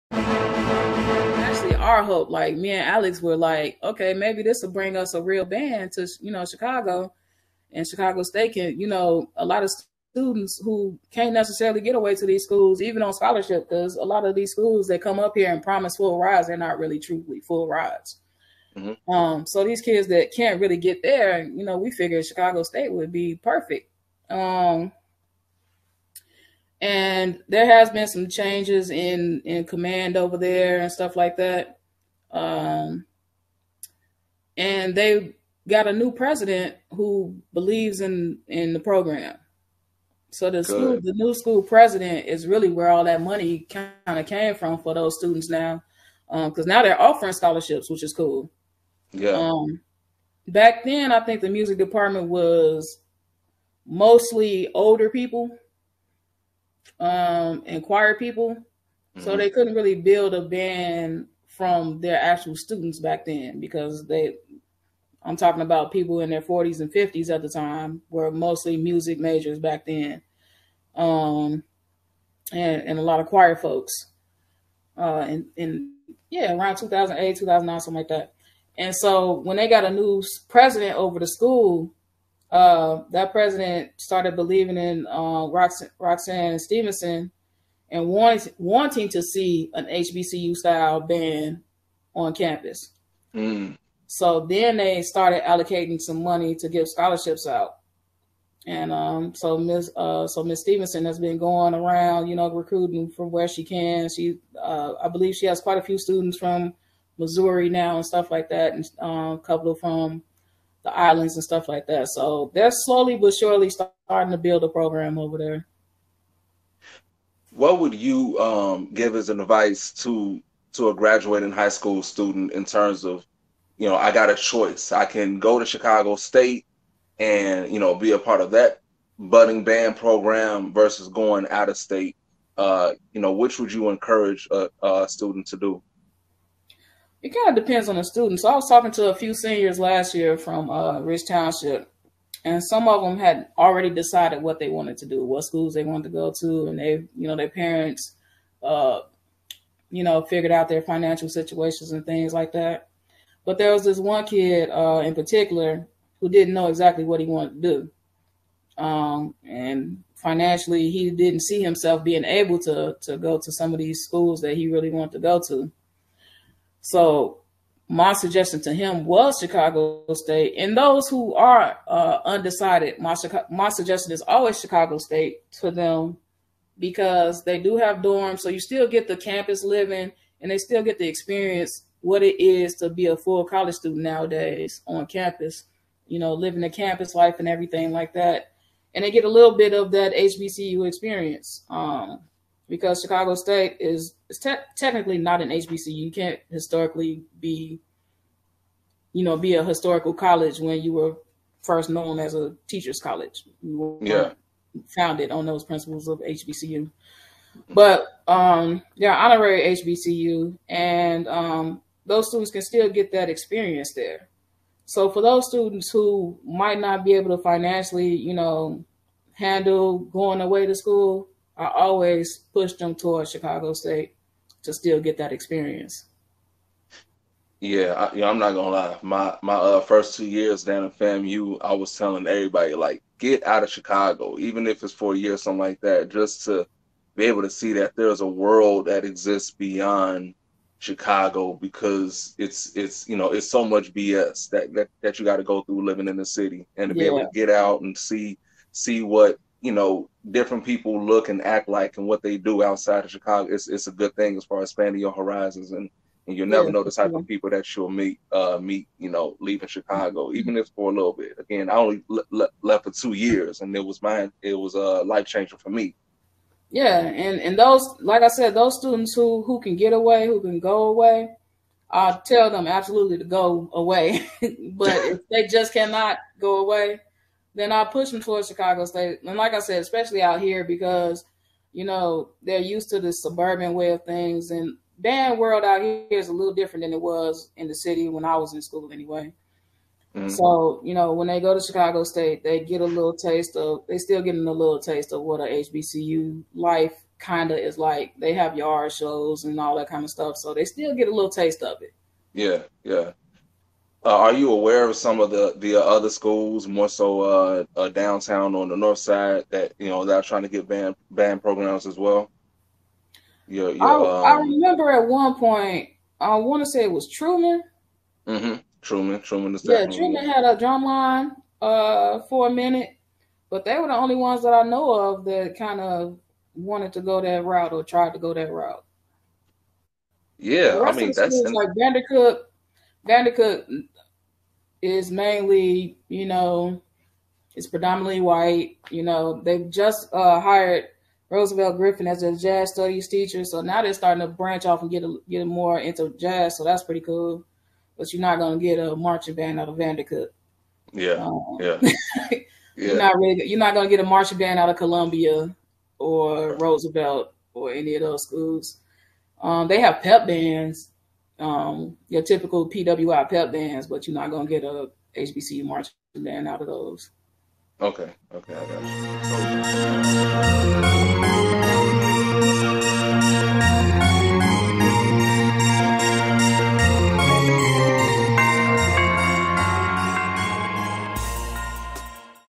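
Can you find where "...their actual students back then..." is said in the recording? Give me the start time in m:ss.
1:01.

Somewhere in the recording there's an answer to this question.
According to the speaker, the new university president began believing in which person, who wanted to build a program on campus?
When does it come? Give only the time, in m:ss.
1:25.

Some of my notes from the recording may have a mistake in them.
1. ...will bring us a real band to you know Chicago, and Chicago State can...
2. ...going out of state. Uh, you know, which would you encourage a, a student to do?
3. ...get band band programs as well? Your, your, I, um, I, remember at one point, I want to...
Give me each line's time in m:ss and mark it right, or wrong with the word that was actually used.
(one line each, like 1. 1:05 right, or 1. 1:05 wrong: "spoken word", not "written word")
1. 0:04 right
2. 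2:11 right
3. 5:10 right.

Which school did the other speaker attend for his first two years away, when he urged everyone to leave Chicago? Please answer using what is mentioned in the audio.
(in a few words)
FAMU.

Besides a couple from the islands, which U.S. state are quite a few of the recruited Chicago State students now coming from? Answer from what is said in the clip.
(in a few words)
Missouri.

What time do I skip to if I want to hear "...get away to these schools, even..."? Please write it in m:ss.
0:11.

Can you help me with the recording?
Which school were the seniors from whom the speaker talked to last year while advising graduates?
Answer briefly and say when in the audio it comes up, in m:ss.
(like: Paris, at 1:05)
Township, at 2:21.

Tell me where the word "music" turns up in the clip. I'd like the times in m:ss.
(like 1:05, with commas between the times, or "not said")
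0:51, 1:08.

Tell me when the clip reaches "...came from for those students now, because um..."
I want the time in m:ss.
0:44.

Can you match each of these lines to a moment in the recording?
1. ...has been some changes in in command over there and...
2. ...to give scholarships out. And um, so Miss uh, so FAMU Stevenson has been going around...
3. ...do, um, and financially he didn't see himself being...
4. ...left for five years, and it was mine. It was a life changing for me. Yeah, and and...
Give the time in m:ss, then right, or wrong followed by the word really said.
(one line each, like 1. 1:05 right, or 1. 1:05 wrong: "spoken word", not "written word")
1. 0:27 right
2. 1:36 wrong: "Miss", not "FAMU"
3. 2:38 right
4. 4:22 wrong: "two", not "five".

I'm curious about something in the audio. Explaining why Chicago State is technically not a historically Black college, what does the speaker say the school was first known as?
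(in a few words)
A teachers' college.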